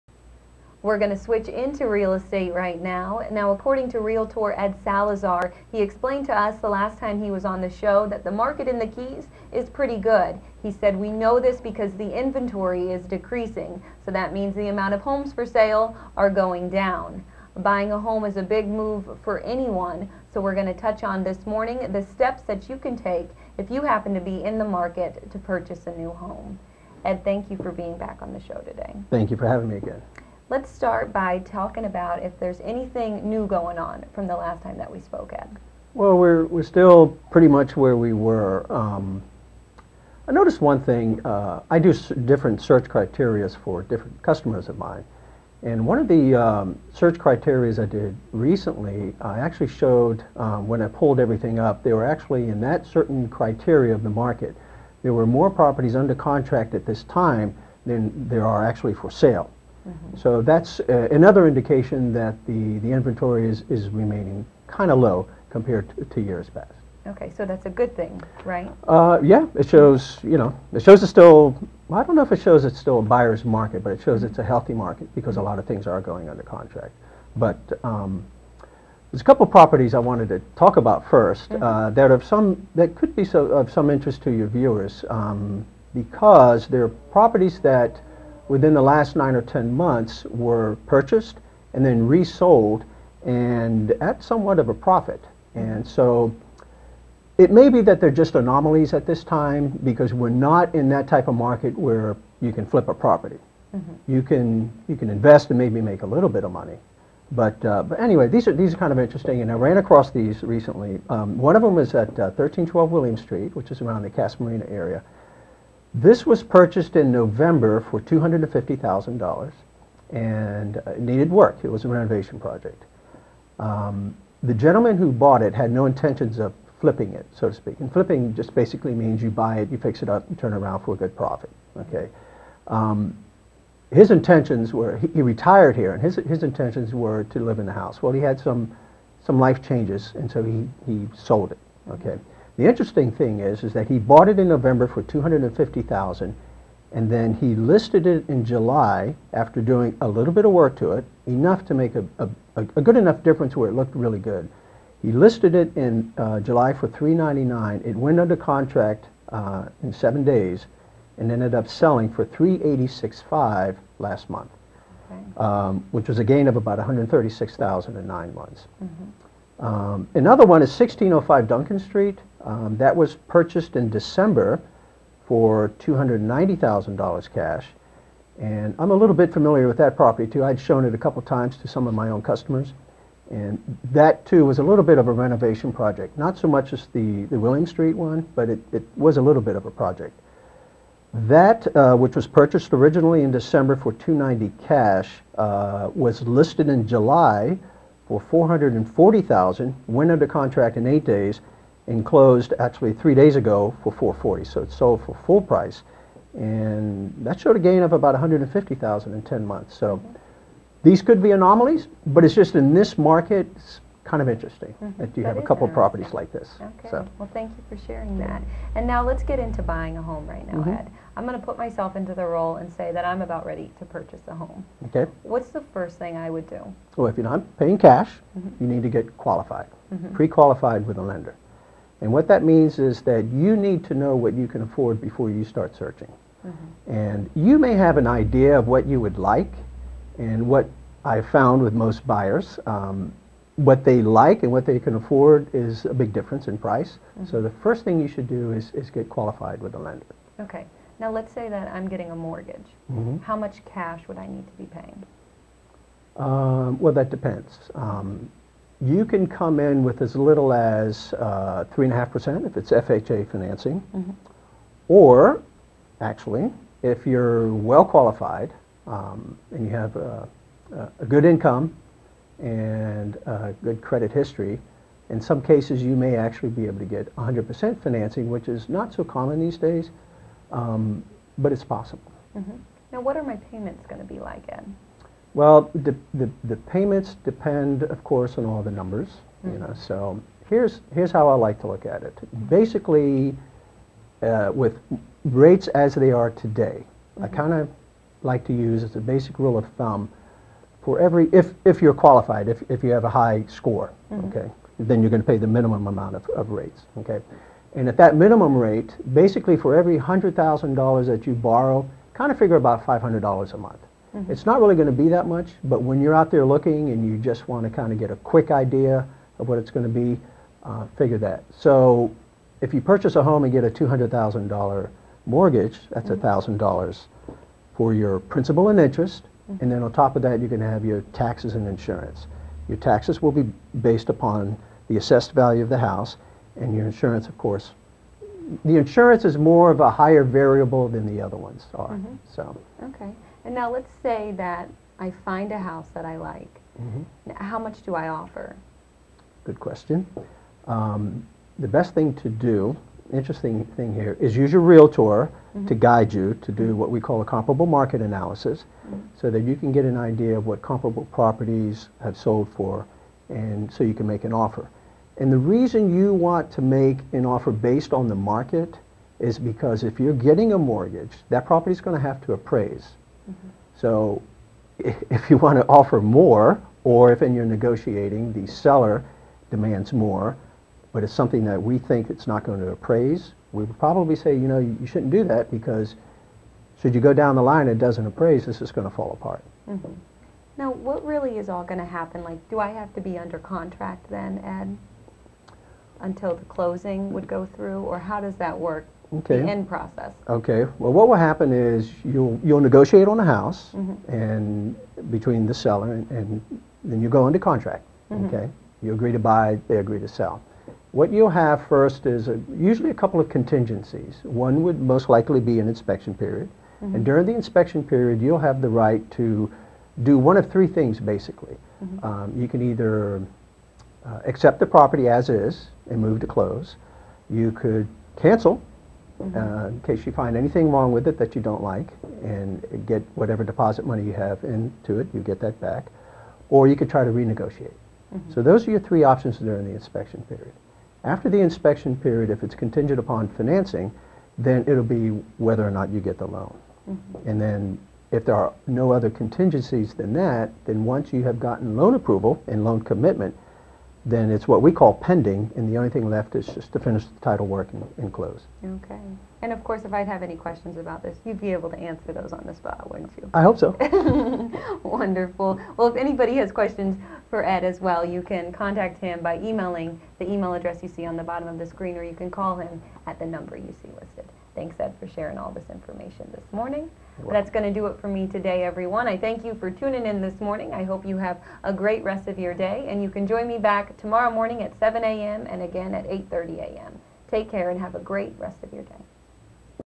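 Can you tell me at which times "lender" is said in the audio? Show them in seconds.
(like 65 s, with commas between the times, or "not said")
231 s, 249 s.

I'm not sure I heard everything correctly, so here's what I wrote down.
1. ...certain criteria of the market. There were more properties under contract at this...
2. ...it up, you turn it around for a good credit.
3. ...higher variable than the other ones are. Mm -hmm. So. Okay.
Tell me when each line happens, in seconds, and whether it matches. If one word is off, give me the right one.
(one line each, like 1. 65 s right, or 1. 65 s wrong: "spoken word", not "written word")
1. 52 s right
2. 130 s wrong: "profit", not "credit"
3. 340 s right.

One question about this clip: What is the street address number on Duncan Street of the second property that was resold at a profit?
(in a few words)
1605.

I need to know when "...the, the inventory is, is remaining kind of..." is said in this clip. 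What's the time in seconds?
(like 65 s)
62 s.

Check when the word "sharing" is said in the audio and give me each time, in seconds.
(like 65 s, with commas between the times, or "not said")
217 s, 475 s.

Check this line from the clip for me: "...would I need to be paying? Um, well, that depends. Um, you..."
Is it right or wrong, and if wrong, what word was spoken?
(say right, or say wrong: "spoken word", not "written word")
right.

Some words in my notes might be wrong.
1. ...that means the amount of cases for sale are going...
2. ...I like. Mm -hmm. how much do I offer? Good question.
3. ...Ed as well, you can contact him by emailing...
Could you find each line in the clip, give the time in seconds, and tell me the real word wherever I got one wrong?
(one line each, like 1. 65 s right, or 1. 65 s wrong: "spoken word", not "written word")
1. 14 s wrong: "homes", not "cases"
2. 346 s right
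3. 467 s right.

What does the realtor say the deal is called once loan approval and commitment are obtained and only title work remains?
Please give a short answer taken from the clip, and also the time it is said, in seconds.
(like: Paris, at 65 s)
pending, at 454 s.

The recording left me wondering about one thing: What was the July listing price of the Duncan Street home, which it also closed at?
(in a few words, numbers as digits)
440,000.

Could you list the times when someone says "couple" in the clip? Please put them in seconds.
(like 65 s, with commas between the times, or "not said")
79 s, 180 s, 215 s, 413 s.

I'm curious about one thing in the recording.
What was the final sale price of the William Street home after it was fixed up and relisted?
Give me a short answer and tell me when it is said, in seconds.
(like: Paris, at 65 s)
386.5, at 162 s.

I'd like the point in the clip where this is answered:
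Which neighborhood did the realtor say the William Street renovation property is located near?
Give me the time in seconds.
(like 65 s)
114 s.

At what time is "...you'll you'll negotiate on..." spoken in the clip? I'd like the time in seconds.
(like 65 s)
402 s.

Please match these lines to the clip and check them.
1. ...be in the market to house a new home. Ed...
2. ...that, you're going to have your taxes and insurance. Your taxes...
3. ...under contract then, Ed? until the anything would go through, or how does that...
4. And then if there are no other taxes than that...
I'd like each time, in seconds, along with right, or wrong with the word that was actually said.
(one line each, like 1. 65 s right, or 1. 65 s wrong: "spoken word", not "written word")
1. 24 s wrong: "purchase", not "house"
2. 330 s right
3. 393 s wrong: "closing", not "anything"
4. 447 s wrong: "contingencies", not "taxes".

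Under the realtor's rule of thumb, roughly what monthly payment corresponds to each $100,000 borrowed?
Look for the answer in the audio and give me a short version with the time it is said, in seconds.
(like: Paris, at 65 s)
$500, at 312 s.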